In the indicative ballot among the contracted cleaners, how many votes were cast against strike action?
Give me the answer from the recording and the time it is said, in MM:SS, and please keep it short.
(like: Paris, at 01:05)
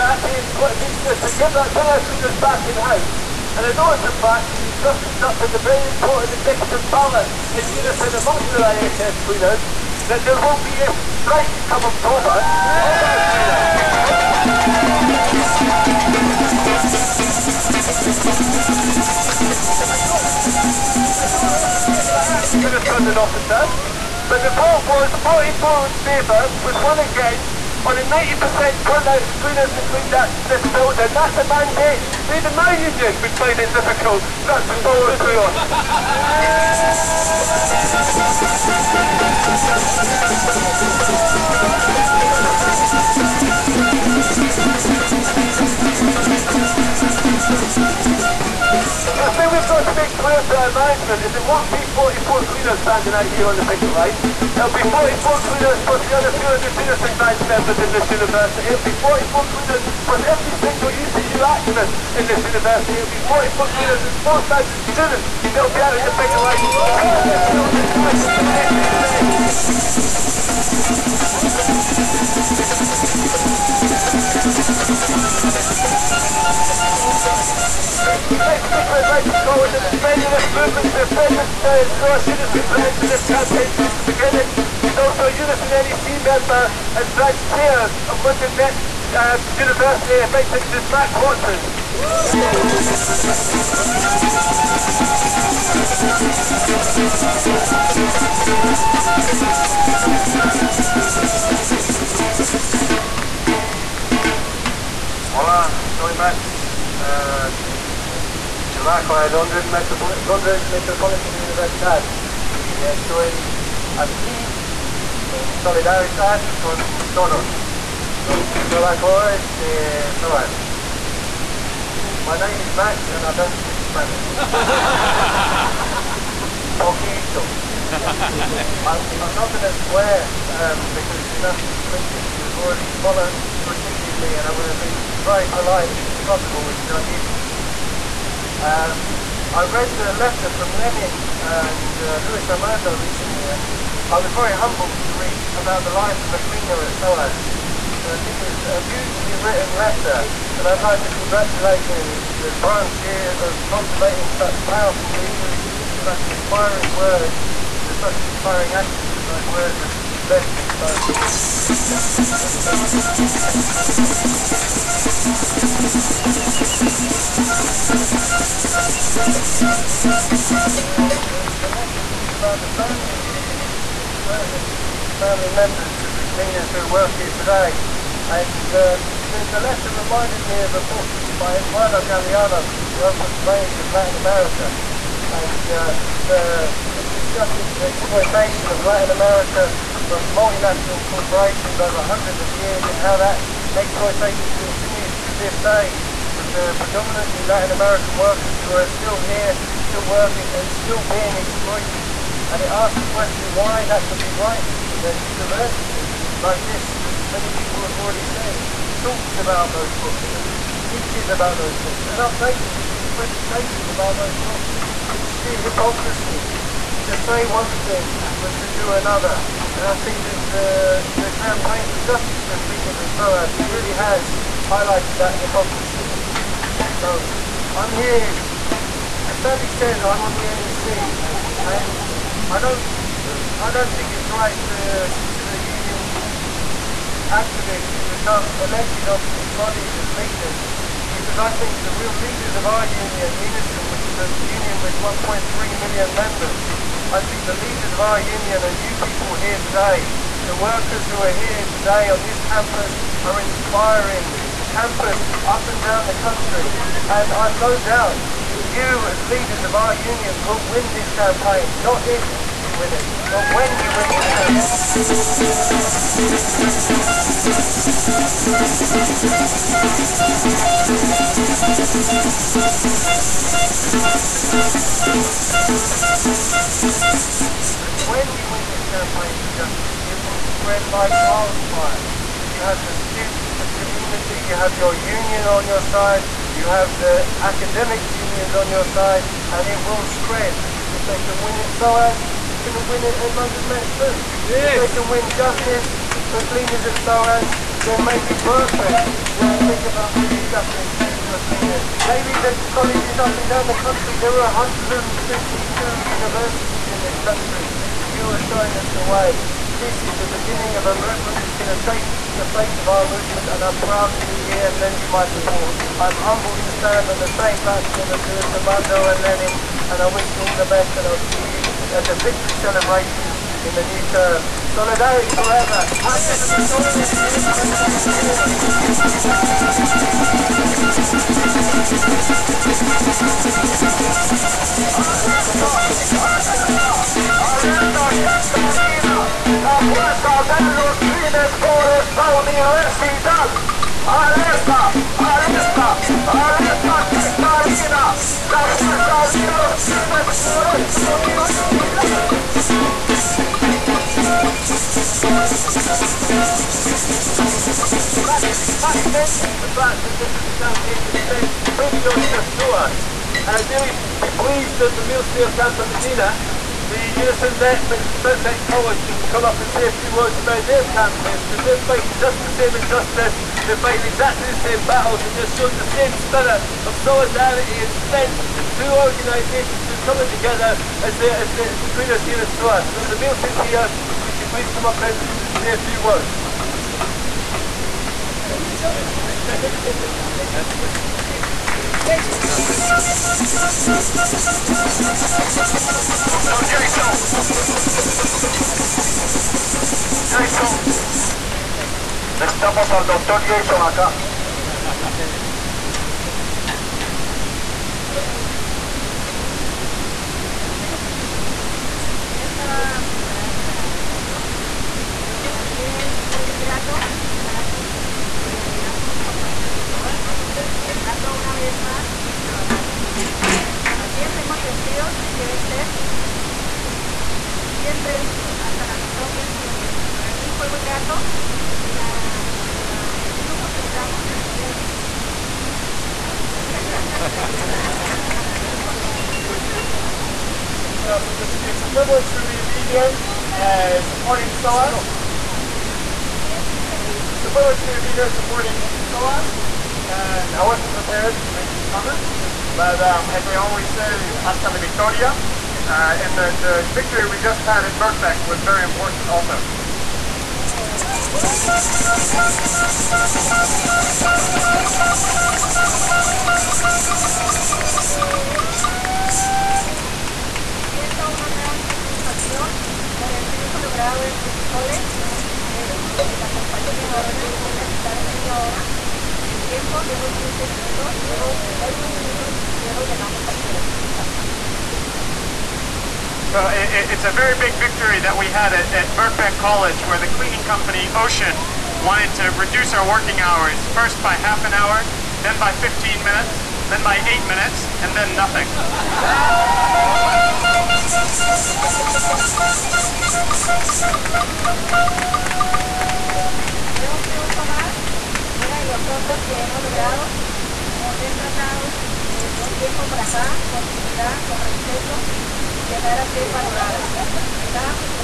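1, at 00:26.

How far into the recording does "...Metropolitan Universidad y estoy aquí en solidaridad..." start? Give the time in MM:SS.
01:50.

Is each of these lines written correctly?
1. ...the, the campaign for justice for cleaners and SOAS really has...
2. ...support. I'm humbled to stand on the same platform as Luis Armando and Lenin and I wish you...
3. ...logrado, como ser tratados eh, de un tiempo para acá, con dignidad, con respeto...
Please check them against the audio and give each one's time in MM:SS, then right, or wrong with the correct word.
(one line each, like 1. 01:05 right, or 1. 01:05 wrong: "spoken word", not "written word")
1. 03:40 right
2. 05:15 right
3. 08:29 right.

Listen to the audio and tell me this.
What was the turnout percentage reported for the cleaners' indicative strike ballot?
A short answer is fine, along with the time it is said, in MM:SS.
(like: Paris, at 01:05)
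90%, at 00:28.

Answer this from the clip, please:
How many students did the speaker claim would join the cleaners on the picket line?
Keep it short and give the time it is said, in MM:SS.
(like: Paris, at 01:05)
4,000, at 01:04.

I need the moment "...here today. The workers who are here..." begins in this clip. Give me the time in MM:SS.
04:09.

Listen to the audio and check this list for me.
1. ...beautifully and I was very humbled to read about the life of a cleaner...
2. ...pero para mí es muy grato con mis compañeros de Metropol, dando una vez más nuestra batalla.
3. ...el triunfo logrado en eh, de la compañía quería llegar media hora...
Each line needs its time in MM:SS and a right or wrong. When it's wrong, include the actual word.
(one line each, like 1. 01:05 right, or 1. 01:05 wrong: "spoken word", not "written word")
1. 02:22 wrong: "recently", not "beautifully"
2. 06:55 wrong: "SOA", not "Metropol"
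3. 07:53 wrong: "quitar", not "llegar".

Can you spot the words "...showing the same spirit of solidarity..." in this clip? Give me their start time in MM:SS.
06:15.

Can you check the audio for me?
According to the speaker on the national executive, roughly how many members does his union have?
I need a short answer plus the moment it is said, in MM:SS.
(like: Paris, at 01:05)
1.3 million, at 04:05.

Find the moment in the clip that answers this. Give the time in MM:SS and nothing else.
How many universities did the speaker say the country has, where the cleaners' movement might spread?
05:04.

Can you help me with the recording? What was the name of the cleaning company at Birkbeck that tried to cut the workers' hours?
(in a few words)
Ocean.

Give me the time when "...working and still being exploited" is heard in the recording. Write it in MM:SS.
03:20.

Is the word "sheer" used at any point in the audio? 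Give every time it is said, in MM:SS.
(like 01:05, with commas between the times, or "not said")
03:35.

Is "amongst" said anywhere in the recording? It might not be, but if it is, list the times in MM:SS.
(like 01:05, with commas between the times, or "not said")
00:08.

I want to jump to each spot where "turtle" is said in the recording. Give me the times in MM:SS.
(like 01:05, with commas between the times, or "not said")
not said.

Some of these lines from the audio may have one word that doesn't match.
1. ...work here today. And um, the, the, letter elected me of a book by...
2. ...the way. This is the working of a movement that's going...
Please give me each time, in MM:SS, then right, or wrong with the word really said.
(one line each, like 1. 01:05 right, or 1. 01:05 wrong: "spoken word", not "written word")
1. 02:56 wrong: "reminded", not "elected"
2. 05:08 wrong: "beginning", not "working".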